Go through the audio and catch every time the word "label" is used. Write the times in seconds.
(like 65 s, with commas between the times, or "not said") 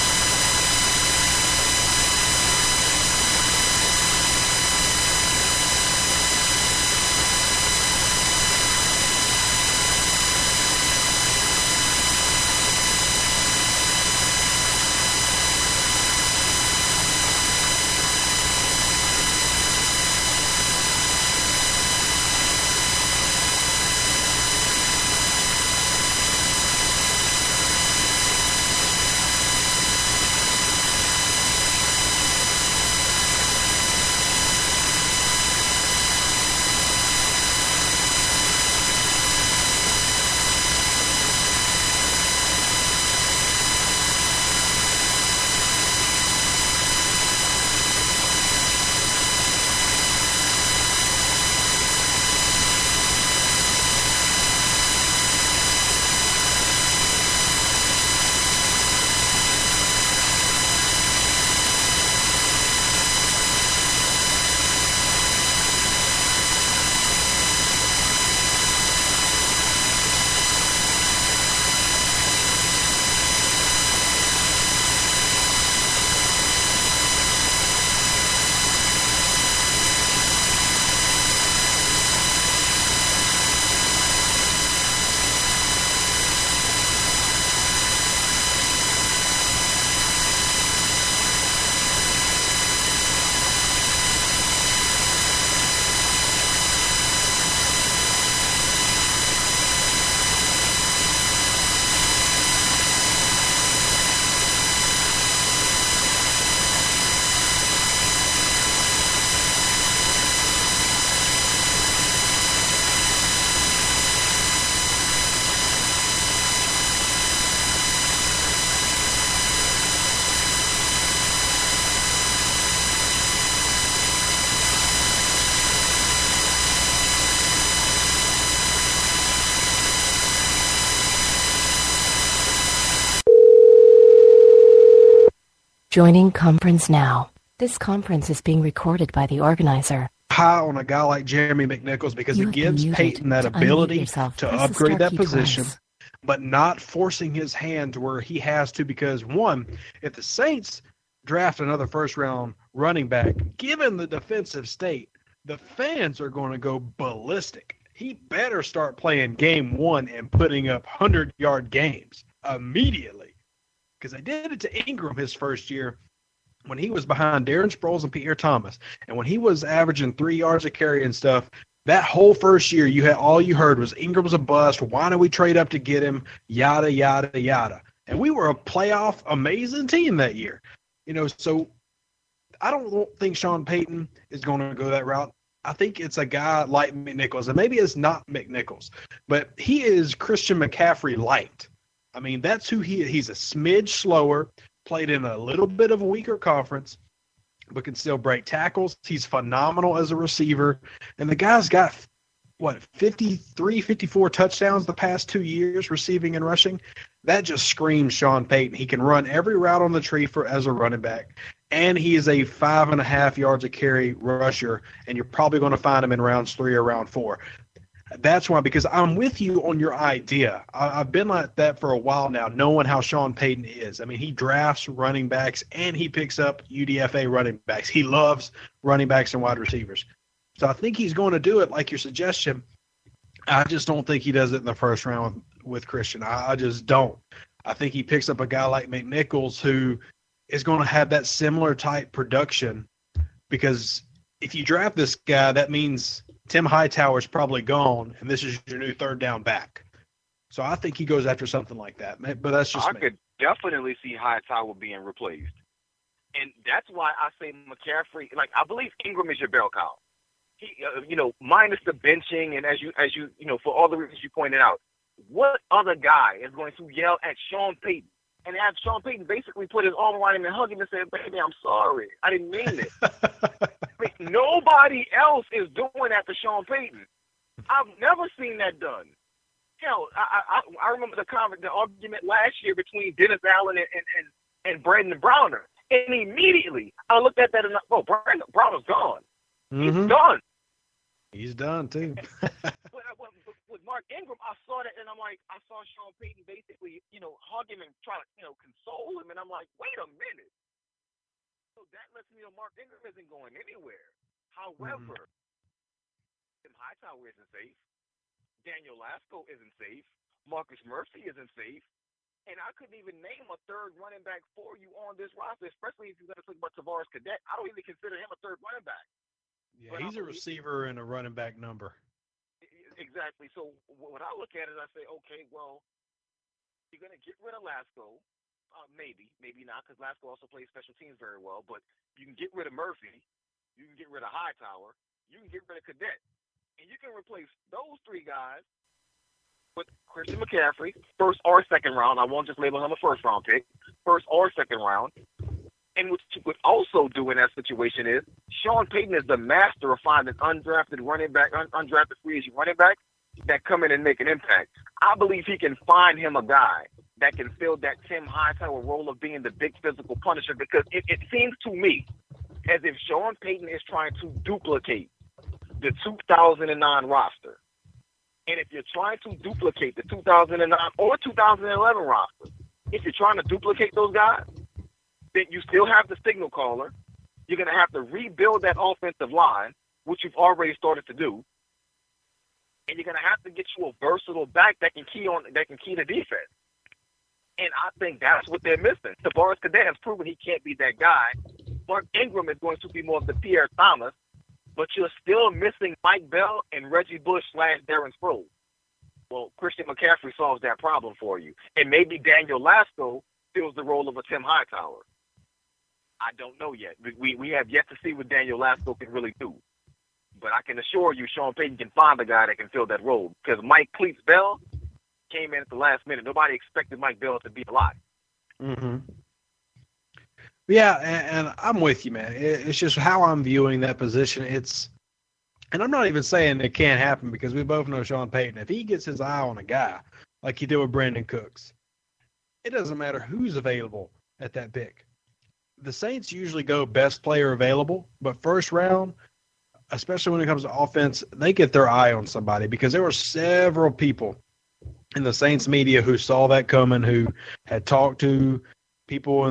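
342 s.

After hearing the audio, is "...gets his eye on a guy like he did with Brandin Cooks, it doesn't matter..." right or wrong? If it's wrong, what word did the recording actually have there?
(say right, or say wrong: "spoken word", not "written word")
right.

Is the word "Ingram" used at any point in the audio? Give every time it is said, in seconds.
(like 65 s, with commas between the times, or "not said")
164 s, 173 s, 259 s, 294 s, 302 s, 392 s.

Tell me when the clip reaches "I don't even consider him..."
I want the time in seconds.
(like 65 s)
317 s.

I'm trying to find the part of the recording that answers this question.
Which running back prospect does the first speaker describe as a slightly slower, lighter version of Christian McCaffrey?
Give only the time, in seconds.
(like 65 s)
141 s.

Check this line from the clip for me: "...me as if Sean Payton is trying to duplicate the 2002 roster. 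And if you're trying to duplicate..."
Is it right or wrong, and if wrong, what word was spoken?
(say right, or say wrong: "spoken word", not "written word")
wrong: "2009", not "2002".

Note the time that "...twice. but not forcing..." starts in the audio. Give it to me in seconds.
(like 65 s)
145 s.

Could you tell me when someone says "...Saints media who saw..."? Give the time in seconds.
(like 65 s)
445 s.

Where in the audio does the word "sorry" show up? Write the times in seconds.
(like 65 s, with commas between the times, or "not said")
271 s.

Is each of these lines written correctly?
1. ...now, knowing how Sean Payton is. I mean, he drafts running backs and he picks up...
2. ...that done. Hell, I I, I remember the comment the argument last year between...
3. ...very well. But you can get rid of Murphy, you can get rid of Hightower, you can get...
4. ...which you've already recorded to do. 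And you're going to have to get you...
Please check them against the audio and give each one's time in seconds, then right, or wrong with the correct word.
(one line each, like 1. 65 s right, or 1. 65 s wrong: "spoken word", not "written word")
1. 222 s right
2. 278 s right
3. 331 s right
4. 380 s wrong: "started", not "recorded".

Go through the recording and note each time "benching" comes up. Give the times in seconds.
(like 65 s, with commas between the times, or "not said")
261 s.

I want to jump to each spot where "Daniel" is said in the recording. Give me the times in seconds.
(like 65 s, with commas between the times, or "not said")
308 s, 402 s, 408 s.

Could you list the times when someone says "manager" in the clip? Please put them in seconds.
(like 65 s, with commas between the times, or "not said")
not said.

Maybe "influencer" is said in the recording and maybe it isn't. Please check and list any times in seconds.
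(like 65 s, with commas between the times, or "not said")
not said.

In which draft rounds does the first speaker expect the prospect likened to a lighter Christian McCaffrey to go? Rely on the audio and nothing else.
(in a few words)
rounds 3 or 4.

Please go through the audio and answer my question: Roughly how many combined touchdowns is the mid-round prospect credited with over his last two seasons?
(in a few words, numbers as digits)
53, 54.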